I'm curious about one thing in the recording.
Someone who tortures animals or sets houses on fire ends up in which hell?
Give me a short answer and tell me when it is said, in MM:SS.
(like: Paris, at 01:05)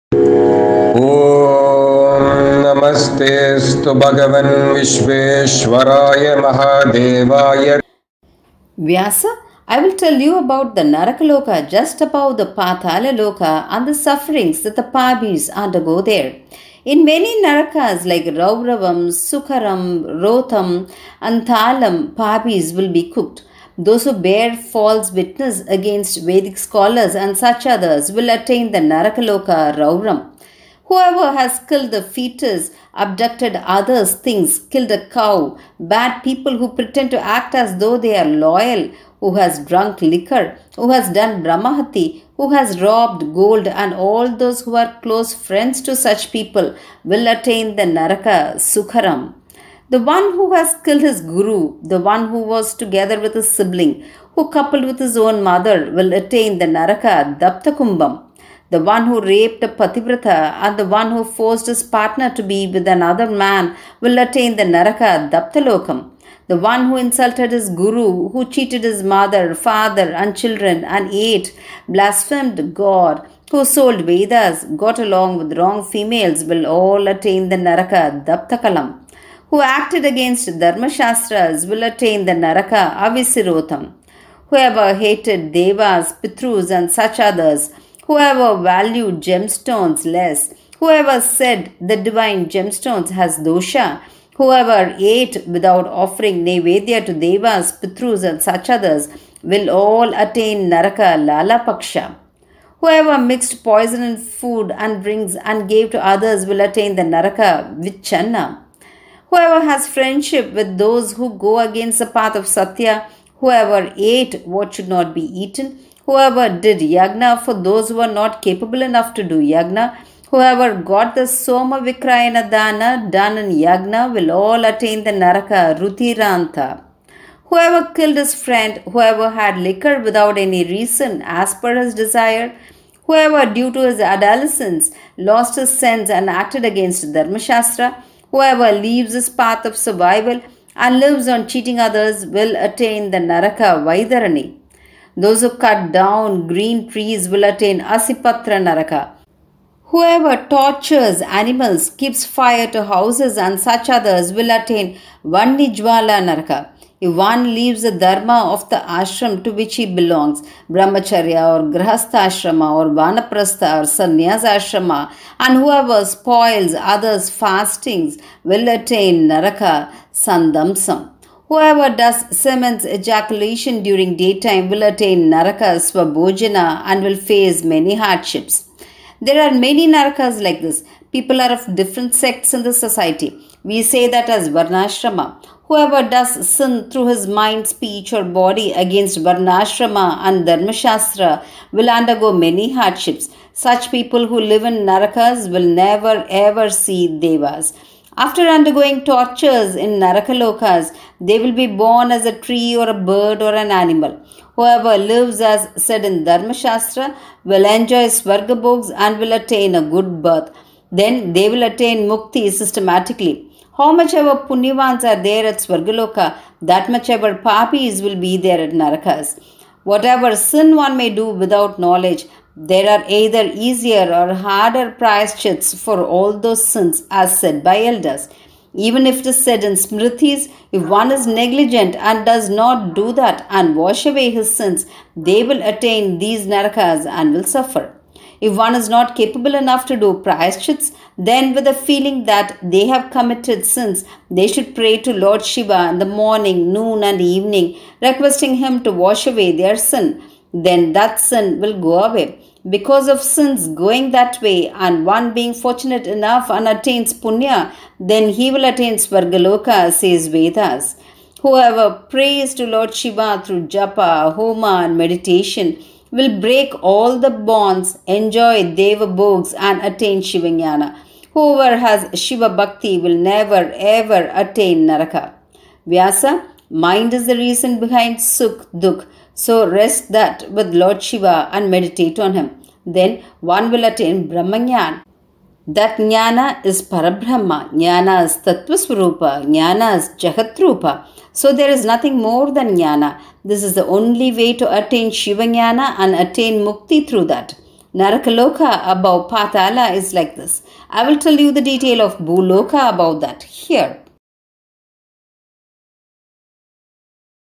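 Vanijwala Naraka, at 02:35.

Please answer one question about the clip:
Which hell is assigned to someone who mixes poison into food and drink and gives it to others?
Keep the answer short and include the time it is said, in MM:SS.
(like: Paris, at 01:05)
Vichanna, at 01:47.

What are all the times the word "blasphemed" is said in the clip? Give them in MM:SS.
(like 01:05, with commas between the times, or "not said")
01:11.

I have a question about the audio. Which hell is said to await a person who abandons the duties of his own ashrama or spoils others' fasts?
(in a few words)
Sandamsam.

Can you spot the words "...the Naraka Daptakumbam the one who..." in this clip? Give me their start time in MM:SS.
00:56.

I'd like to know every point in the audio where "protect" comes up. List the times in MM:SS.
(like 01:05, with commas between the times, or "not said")
not said.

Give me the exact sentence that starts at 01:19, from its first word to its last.
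Who acted against Dharma Shastras will attain the Naraka Avisirotham.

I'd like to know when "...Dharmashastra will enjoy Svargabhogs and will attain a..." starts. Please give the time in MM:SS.
03:26.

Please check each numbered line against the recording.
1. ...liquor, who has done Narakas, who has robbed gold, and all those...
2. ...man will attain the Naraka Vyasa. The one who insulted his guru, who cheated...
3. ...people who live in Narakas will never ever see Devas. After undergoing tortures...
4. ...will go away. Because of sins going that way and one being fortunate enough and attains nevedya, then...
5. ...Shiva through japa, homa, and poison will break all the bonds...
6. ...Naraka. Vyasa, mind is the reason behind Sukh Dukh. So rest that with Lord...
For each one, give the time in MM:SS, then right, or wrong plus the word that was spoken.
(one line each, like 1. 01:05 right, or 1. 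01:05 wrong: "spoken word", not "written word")
1. 00:40 wrong: "Brahmahati", not "Narakas"
2. 01:03 wrong: "Daptalokam", not "Vyasa"
3. 03:13 right
4. 04:11 wrong: "punya", not "nevedya"
5. 04:22 wrong: "meditation", not "poison"
6. 04:34 right.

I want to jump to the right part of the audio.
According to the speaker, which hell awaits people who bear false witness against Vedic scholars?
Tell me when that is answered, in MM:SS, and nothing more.
00:29.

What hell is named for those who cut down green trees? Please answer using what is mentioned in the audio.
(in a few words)
Asipatra Naraka.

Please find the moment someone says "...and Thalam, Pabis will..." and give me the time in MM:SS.
00:21.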